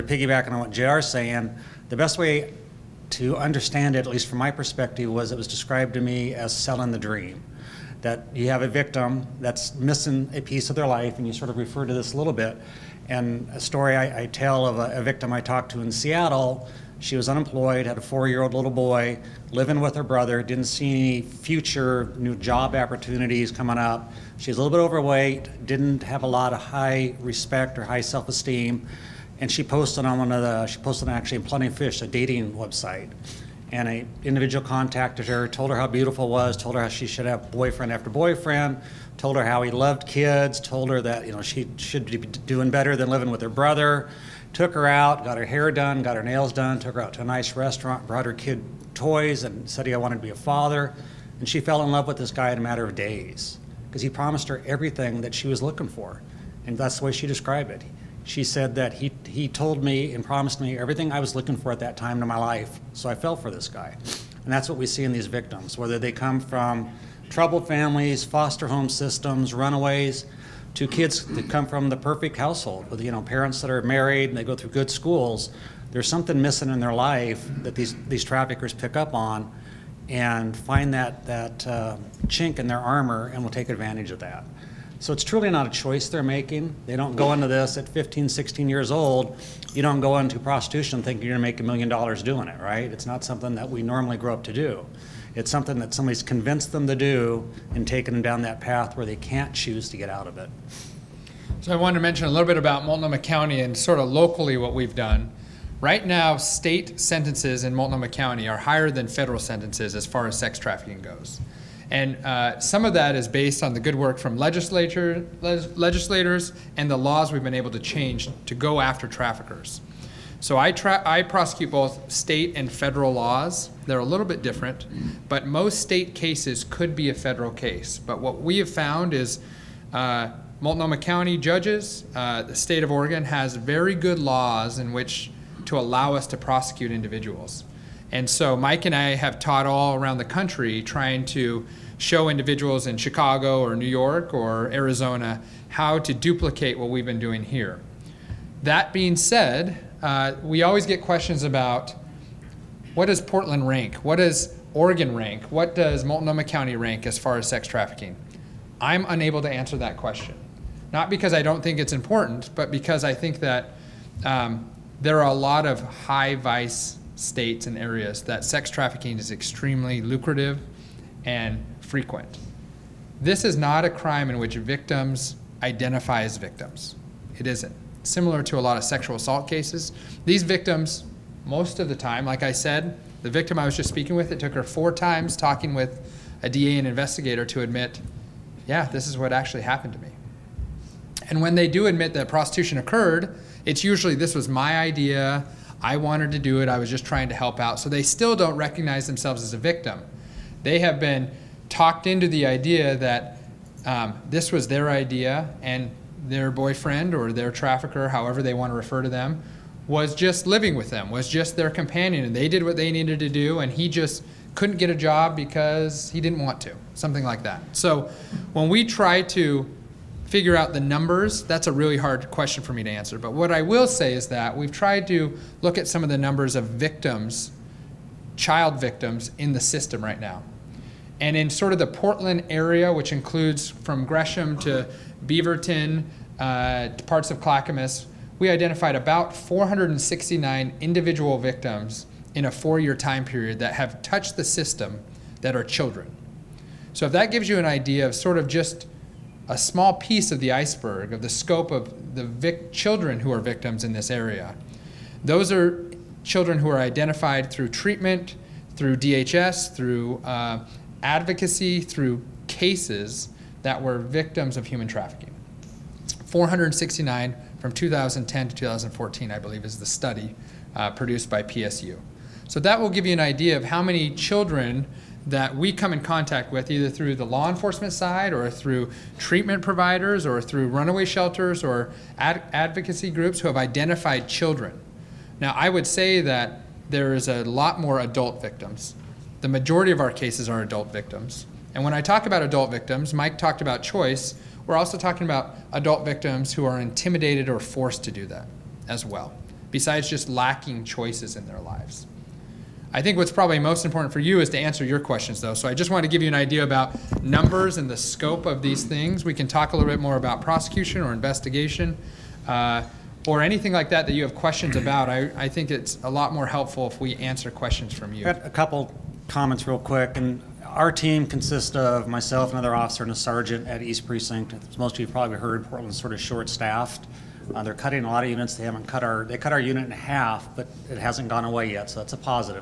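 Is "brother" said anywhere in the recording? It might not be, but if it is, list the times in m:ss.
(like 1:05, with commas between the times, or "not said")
0:20, 0:43.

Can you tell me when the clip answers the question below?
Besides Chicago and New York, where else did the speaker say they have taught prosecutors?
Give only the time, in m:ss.
2:24.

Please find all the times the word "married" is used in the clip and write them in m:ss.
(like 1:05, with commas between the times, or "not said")
1:13.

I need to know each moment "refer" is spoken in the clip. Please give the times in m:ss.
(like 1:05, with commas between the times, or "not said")
0:11, 3:28.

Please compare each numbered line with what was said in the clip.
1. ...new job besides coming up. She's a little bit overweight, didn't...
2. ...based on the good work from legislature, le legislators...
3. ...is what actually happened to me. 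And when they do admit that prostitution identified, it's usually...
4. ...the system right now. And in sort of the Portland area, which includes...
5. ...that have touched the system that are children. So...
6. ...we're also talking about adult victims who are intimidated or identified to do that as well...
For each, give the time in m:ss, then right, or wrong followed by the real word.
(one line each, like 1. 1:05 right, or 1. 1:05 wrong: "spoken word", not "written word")
1. 0:22 wrong: "opportunities", not "besides"
2. 1:53 right
3. 3:09 wrong: "occurred", not "identified"
4. 3:49 right
5. 4:03 right
6. 4:54 wrong: "forced", not "identified".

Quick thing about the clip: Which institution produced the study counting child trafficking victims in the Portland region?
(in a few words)
PSU.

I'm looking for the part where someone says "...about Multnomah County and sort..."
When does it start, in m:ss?
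1:42.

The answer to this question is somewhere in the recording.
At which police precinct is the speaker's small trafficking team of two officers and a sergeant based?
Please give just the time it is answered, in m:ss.
5:23.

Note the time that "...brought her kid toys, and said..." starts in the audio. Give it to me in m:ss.
0:48.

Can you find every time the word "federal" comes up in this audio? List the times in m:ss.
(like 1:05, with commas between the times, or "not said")
1:49, 2:02, 2:07.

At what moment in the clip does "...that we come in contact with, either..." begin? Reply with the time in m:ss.
4:35.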